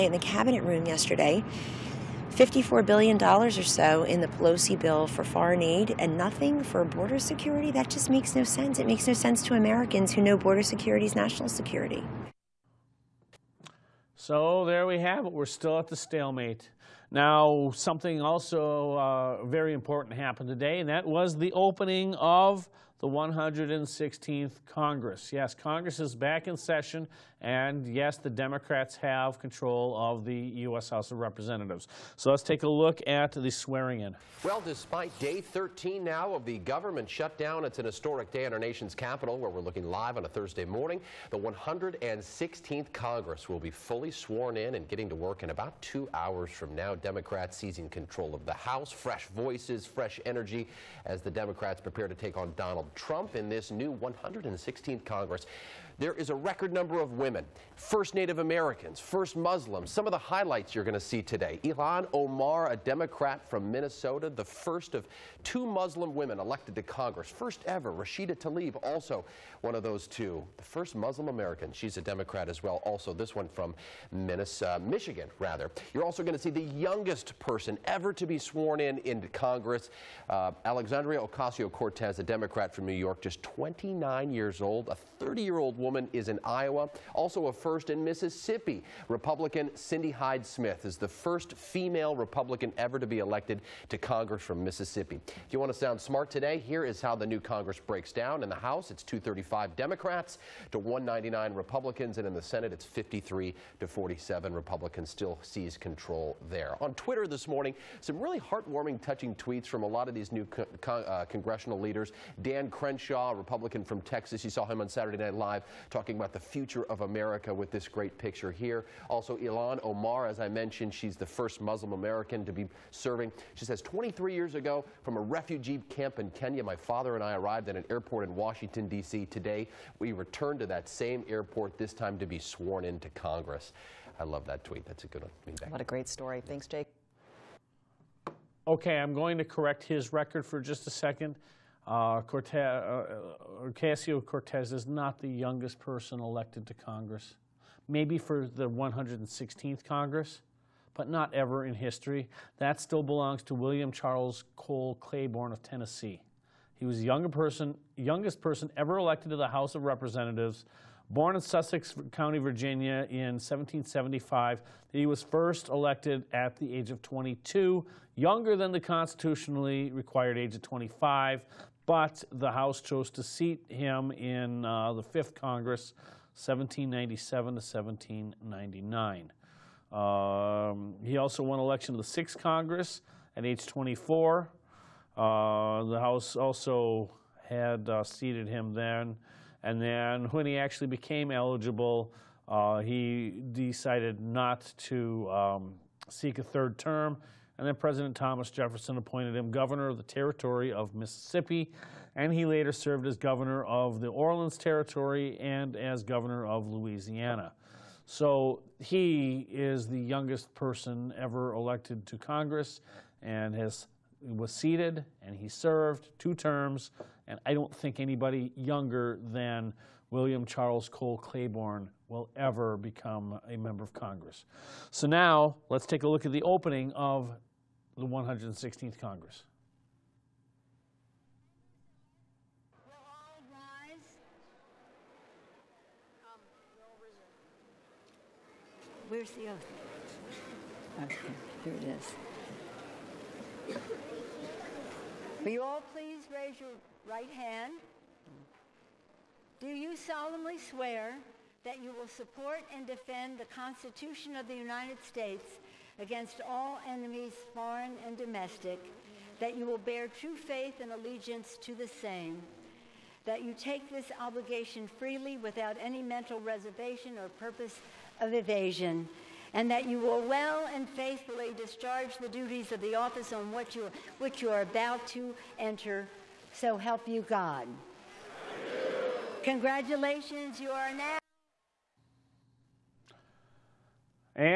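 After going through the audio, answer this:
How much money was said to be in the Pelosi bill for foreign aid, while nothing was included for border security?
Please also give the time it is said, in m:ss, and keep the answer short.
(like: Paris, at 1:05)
$54 billion, at 0:02.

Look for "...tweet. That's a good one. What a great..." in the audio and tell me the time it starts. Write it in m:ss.
2:14.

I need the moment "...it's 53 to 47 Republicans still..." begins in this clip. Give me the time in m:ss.
1:42.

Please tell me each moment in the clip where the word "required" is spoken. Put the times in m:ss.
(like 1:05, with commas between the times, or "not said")
2:49.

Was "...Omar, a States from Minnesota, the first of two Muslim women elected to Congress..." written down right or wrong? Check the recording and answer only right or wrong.
wrong.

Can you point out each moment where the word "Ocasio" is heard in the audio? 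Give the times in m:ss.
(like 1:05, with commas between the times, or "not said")
1:21, 2:23.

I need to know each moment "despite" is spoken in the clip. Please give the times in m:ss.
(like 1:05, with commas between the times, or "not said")
0:34.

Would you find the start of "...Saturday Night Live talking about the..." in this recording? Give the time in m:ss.
1:54.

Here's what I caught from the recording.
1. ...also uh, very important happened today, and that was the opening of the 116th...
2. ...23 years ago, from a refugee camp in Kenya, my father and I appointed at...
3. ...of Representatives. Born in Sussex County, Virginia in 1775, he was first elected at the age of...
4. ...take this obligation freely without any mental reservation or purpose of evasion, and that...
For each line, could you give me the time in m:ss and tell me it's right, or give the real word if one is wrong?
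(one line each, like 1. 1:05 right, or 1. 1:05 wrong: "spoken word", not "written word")
1. 0:18 right
2. 2:03 wrong: "arrived", not "appointed"
3. 2:39 right
4. 4:23 right.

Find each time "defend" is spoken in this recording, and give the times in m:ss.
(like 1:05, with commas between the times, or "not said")
4:12.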